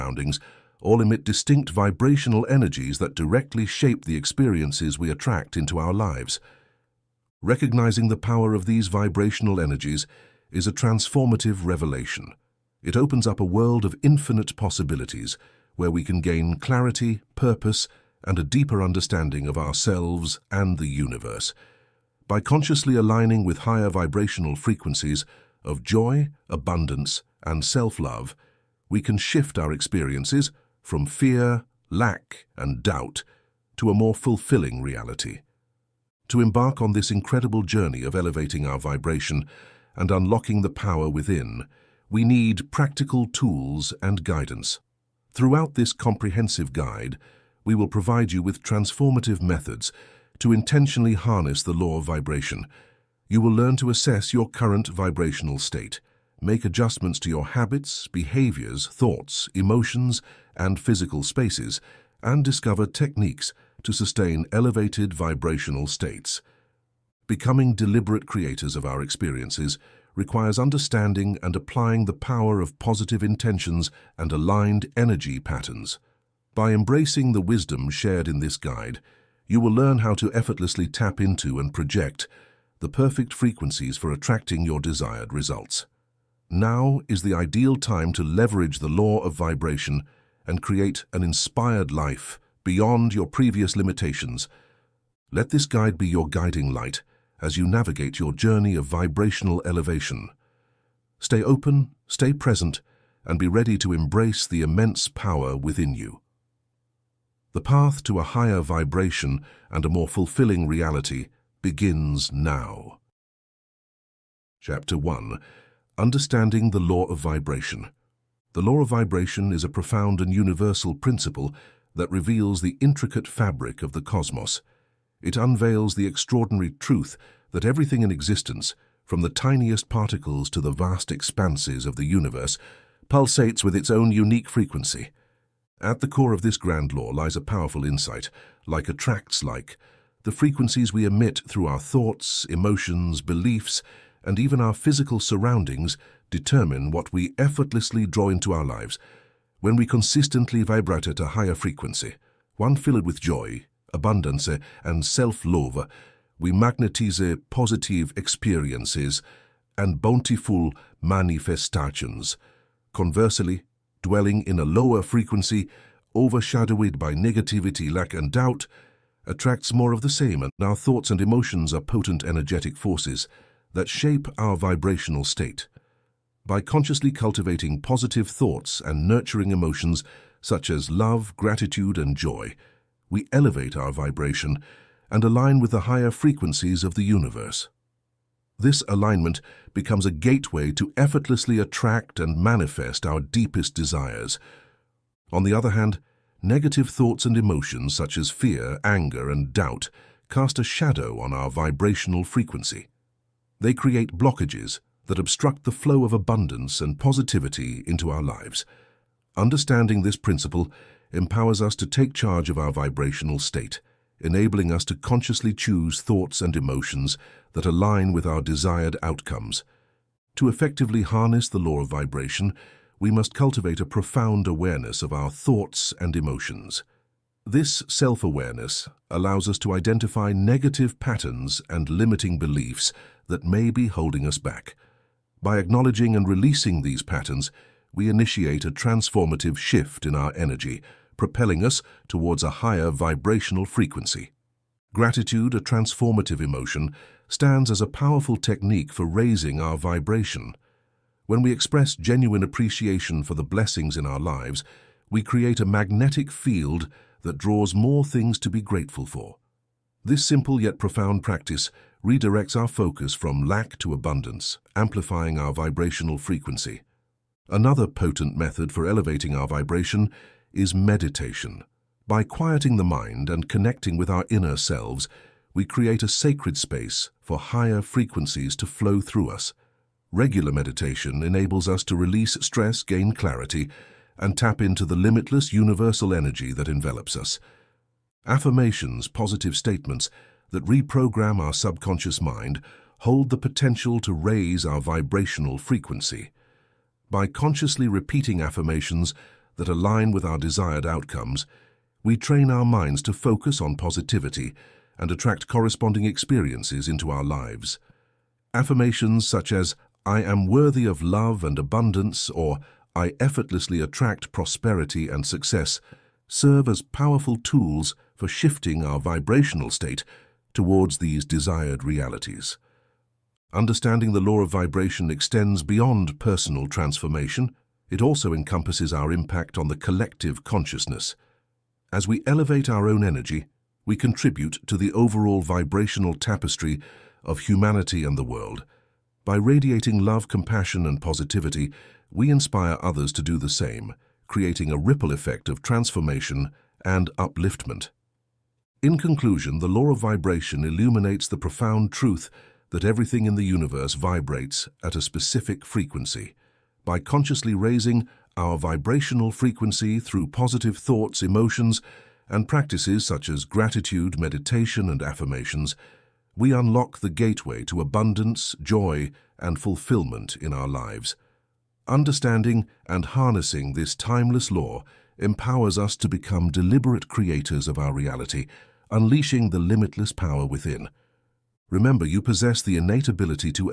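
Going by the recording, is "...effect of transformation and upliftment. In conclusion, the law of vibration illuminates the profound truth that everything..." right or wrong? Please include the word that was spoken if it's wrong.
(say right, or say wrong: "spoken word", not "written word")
right.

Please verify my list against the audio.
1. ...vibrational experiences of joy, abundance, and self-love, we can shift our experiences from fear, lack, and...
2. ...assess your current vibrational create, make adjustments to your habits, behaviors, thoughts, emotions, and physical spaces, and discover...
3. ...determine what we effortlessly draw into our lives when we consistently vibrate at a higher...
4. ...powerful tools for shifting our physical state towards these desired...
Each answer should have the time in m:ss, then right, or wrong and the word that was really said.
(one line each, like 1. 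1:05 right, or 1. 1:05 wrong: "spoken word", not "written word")
1. 0:23 wrong: "frequencies", not "experiences"
2. 0:53 wrong: "state", not "create"
3. 2:26 right
4. 5:16 wrong: "vibrational", not "physical".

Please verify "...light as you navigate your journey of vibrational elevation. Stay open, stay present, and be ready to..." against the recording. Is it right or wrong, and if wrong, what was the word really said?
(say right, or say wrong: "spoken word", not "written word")
right.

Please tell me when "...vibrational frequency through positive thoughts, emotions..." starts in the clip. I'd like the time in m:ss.
5:58.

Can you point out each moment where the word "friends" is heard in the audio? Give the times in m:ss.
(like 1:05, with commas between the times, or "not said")
not said.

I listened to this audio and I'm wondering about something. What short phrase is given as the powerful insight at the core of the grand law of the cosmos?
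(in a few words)
like attracts like.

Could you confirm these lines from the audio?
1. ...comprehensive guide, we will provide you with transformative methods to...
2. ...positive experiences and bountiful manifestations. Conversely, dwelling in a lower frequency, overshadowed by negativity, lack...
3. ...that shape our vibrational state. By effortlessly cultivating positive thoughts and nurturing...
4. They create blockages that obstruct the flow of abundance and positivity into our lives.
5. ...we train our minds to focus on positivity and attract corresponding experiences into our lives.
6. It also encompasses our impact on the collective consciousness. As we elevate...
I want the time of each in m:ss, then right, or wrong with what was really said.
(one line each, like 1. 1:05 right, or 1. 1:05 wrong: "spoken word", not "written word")
1. 0:45 right
2. 2:37 right
3. 2:53 wrong: "consciously", not "effortlessly"
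4. 3:23 right
5. 5:02 right
6. 5:27 right.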